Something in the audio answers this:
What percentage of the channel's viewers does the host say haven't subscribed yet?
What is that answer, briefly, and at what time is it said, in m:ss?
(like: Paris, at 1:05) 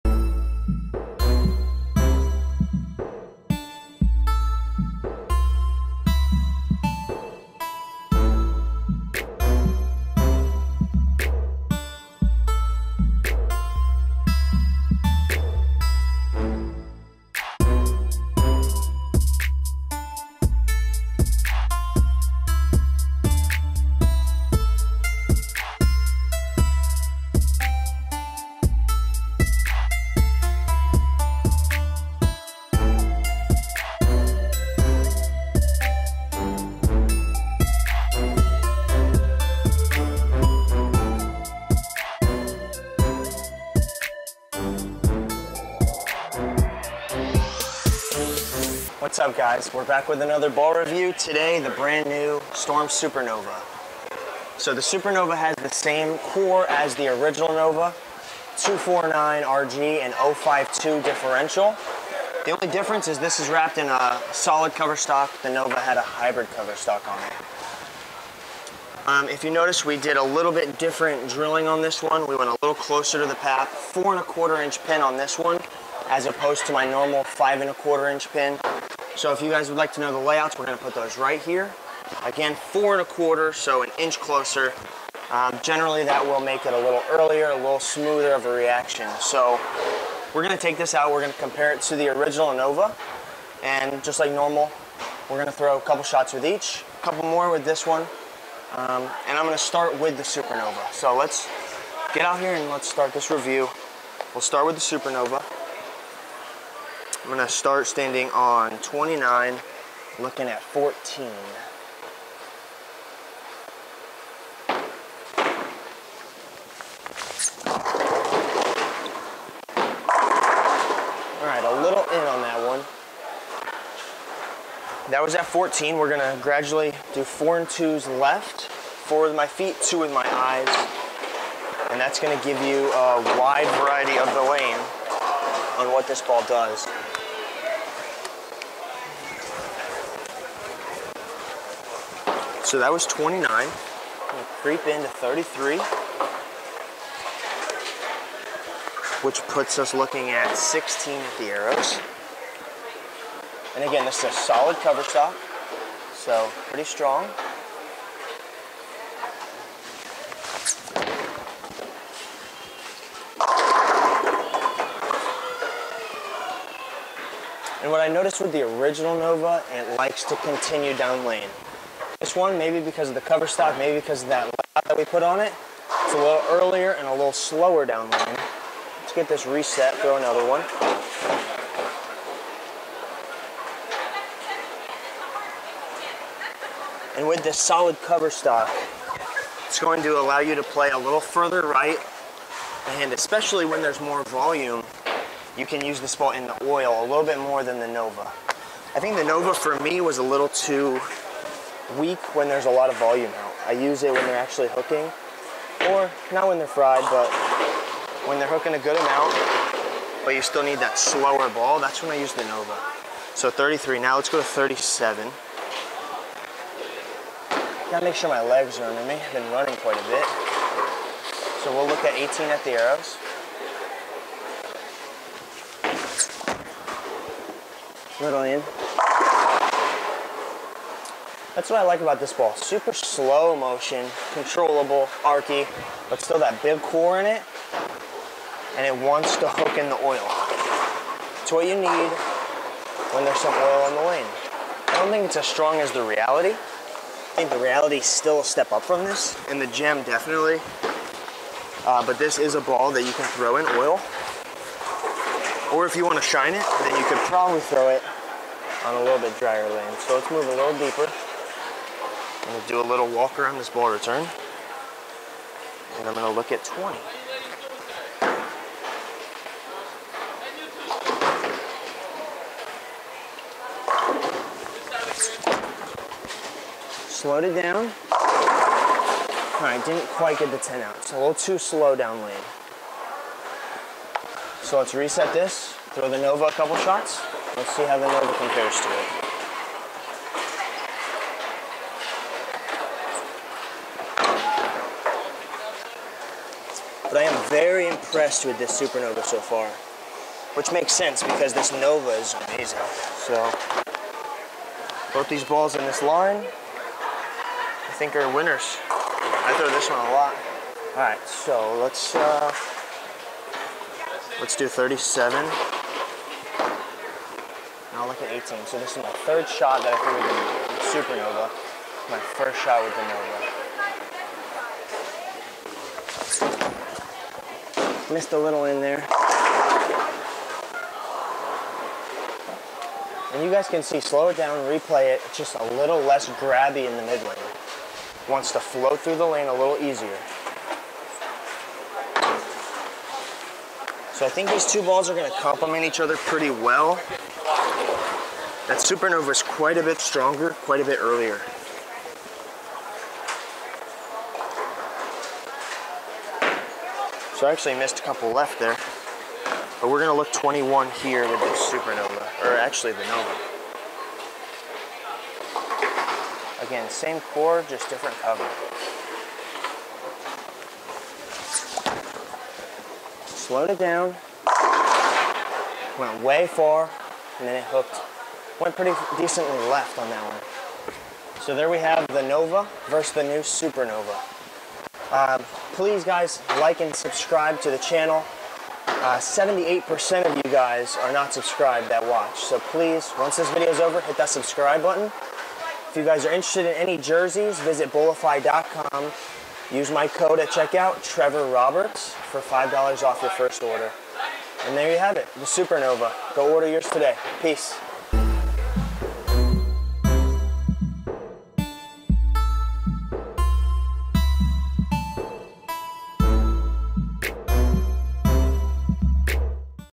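78%, at 6:28.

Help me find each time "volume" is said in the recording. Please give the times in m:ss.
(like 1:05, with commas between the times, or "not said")
3:14, 3:22.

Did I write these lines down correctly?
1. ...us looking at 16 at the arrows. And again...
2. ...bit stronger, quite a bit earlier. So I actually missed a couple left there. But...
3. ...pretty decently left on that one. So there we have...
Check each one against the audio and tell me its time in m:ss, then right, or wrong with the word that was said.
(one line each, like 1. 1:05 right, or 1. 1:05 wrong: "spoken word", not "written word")
1. 2:29 right
2. 5:49 right
3. 6:18 right.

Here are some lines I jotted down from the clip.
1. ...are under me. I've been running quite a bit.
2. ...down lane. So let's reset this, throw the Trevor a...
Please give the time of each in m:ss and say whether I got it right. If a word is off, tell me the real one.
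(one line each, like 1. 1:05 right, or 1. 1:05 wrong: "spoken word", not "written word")
1. 3:38 right
2. 4:41 wrong: "Nova", not "Trevor".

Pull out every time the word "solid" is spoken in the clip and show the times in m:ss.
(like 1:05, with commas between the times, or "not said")
1:04, 2:34, 3:07.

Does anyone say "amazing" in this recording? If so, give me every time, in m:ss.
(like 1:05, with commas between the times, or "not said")
5:02.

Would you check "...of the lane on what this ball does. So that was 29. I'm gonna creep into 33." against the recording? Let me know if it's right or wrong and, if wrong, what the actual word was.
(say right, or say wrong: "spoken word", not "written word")
right.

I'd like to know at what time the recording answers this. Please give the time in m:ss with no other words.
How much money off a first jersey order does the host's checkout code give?
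6:42.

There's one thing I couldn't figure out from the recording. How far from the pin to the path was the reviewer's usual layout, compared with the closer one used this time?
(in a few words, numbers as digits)
5 1/4 inch.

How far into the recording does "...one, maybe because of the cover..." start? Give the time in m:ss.
2:52.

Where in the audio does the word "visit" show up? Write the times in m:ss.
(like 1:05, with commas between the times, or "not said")
6:37.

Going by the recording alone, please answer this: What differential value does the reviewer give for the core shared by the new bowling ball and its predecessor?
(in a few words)
052.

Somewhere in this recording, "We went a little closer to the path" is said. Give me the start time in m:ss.
1:12.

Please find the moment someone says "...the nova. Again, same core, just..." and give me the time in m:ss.
6:02.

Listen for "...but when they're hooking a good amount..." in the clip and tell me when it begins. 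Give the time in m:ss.
3:27.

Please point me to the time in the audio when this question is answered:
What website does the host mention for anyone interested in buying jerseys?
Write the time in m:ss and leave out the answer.
6:37.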